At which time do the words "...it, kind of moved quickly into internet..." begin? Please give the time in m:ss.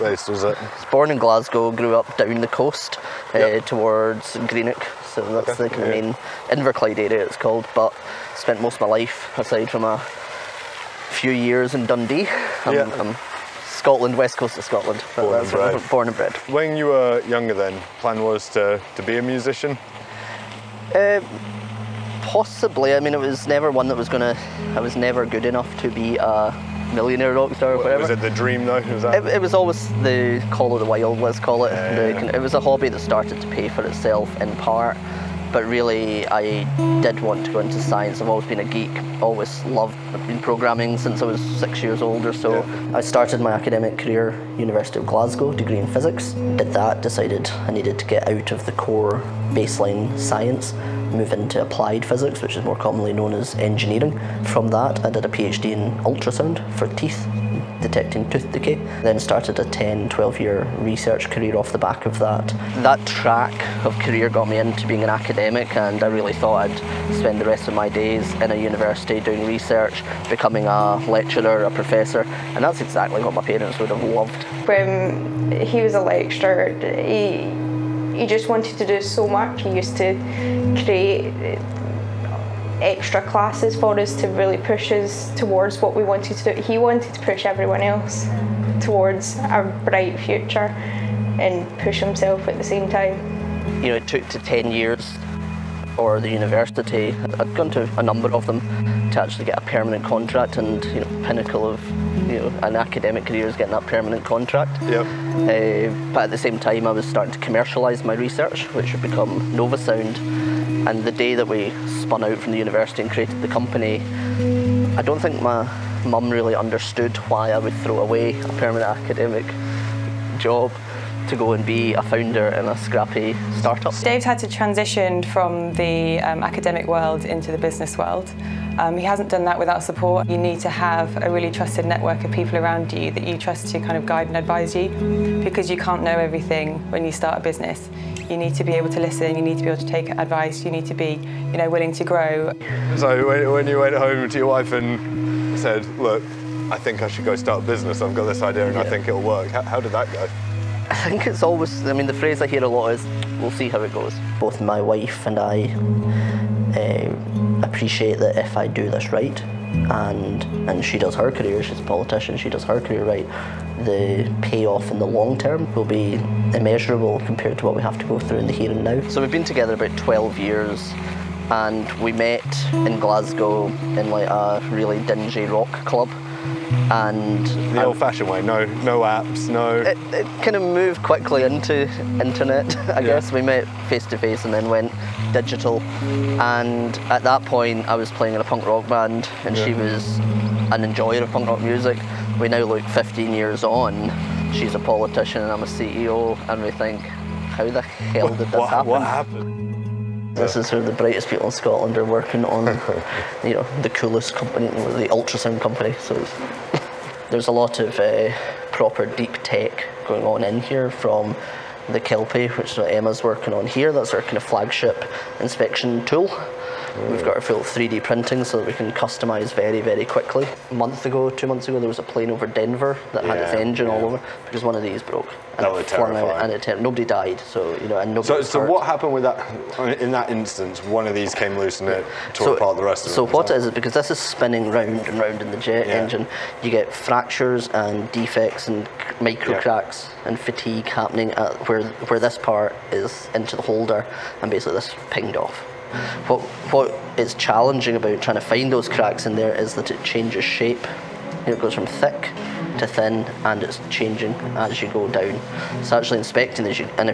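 3:00.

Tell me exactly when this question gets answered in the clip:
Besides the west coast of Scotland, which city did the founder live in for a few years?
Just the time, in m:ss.
0:11.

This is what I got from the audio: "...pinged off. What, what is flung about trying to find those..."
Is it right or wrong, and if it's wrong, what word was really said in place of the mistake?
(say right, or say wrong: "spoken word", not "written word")
wrong: "challenging", not "flung".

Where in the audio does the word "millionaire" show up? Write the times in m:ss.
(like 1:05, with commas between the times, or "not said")
0:26.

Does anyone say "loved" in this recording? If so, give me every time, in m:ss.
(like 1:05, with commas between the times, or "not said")
0:39, 1:14.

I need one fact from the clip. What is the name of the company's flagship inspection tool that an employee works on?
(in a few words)
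Kelpie.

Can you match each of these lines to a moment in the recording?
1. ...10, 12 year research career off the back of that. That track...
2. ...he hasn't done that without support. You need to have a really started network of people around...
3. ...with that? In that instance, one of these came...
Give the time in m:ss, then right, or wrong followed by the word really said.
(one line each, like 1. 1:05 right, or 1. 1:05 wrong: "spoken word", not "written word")
1. 0:59 right
2. 2:08 wrong: "trusted", not "started"
3. 3:49 right.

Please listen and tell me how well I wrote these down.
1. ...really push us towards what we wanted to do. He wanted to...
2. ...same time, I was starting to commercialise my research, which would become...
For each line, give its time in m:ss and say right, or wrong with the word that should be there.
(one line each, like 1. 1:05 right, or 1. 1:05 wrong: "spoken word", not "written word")
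1. 1:24 right
2. 1:46 right.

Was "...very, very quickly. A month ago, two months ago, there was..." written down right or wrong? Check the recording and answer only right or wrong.
right.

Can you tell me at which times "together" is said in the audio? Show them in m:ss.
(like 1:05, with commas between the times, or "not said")
2:49.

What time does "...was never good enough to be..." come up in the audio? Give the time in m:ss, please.
0:24.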